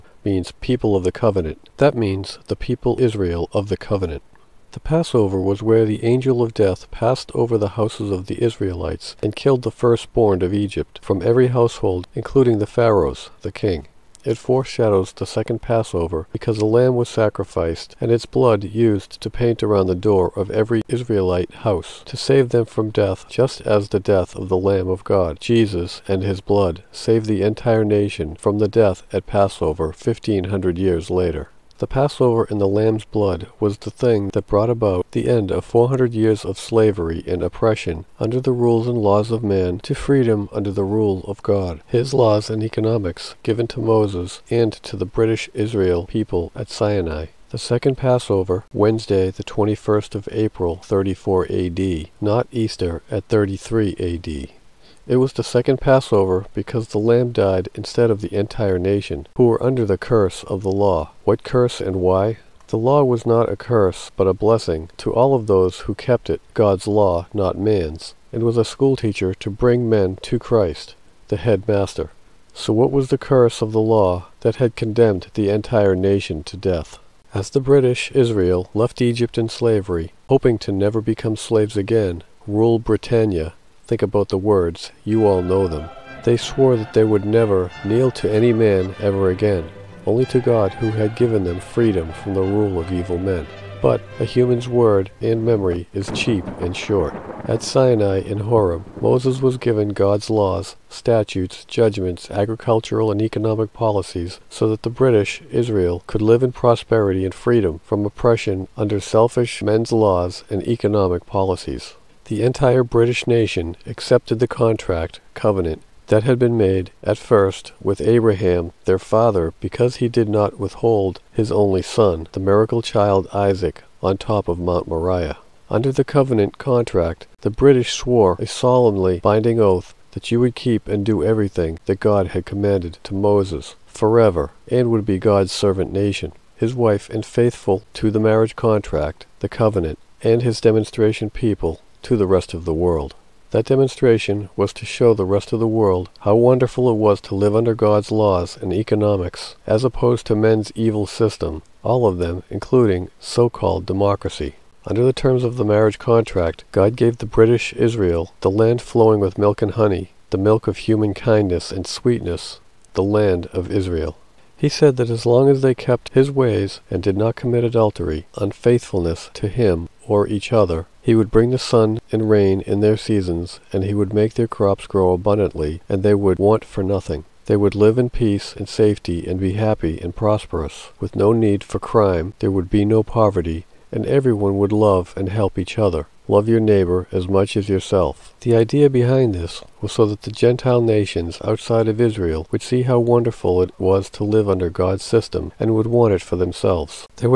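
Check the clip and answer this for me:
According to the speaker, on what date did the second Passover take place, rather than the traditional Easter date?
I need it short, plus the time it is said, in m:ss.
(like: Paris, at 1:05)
Wednesday, 21 April, 34 AD, at 0:48.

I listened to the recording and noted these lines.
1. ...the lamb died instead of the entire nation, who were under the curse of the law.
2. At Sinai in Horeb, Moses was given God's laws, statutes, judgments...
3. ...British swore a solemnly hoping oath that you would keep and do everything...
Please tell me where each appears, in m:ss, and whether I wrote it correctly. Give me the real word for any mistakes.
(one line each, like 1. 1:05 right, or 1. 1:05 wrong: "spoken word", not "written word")
1. 0:56 right
2. 1:37 right
3. 2:07 wrong: "binding", not "hoping".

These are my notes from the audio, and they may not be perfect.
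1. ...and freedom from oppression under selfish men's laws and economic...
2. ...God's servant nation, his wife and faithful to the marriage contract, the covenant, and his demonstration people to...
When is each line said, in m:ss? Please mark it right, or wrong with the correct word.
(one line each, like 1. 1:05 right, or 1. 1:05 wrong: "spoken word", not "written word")
1. 1:47 right
2. 2:15 right.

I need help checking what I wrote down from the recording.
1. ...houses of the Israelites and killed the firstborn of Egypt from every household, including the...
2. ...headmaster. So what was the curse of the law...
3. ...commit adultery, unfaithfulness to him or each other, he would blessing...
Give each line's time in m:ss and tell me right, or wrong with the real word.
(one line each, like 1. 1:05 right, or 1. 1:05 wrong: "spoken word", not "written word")
1. 0:07 right
2. 1:11 right
3. 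2:47 wrong: "bring", not "blessing".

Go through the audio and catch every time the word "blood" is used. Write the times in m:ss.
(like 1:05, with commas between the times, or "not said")
0:18, 0:26, 0:33.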